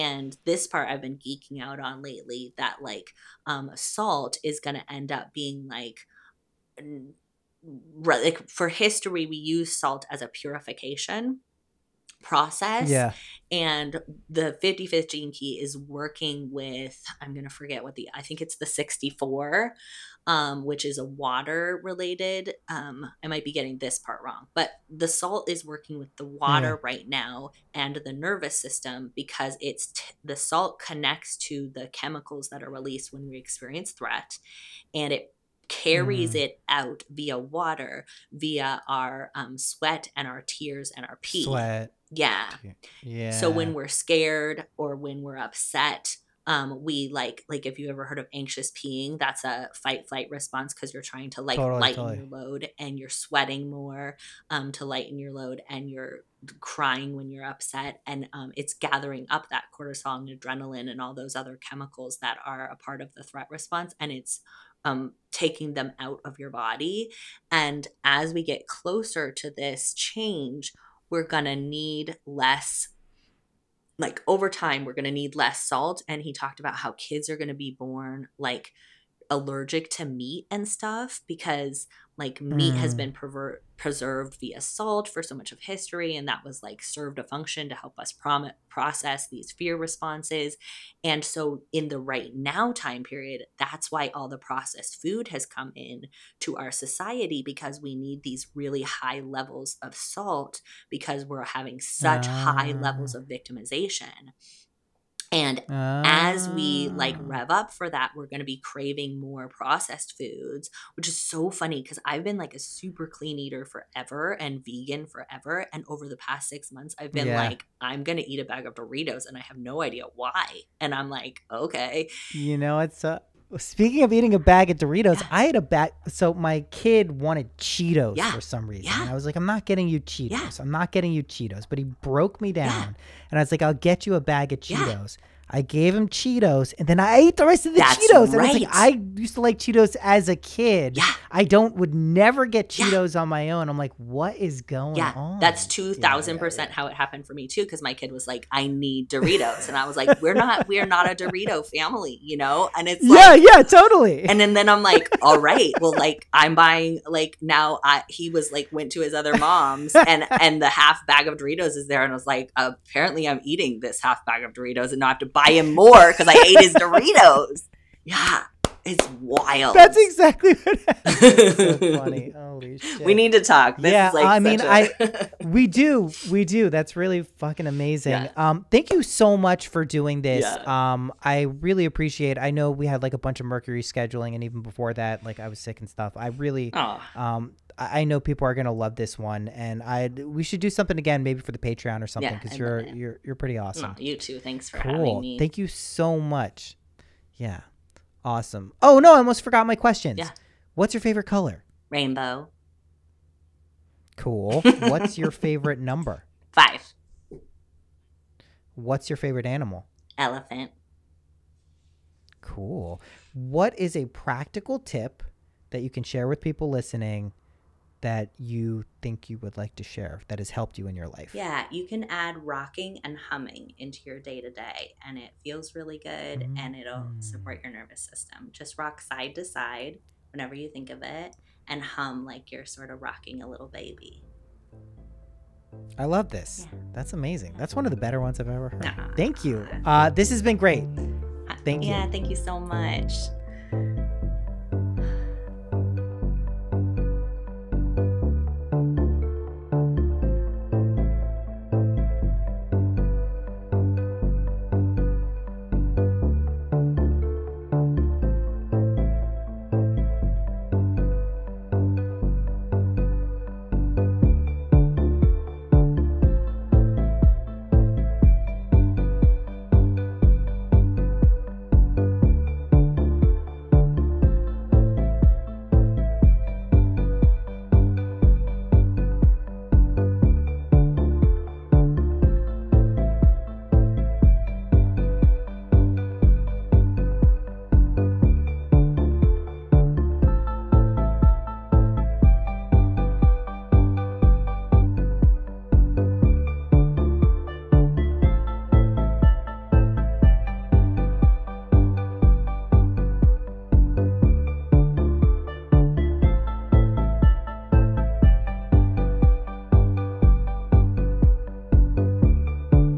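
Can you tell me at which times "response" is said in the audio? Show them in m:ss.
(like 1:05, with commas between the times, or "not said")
0:50, 1:03, 1:29.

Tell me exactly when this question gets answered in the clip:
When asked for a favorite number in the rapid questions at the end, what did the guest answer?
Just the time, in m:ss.
3:26.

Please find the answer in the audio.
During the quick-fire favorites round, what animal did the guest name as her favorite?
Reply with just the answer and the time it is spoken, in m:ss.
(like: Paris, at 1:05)
Elephant, at 3:30.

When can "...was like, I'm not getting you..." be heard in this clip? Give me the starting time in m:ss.
2:09.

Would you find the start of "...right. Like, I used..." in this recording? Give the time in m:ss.
2:18.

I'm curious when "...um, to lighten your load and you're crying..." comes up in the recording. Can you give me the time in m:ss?
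0:54.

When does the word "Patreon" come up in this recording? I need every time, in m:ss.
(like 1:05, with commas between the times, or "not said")
3:11.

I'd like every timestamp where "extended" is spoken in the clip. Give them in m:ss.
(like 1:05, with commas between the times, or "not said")
not said.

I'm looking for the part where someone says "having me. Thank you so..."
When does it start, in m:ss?
3:14.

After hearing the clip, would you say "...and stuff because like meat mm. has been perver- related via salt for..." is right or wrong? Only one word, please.
wrong.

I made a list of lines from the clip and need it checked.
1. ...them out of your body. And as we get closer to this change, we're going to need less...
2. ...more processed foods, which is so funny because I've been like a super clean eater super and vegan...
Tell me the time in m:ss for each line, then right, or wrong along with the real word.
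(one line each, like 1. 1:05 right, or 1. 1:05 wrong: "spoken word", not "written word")
1. 1:05 right
2. 1:49 wrong: "forever", not "super".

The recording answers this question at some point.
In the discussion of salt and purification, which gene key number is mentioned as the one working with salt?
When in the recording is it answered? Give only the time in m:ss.
0:14.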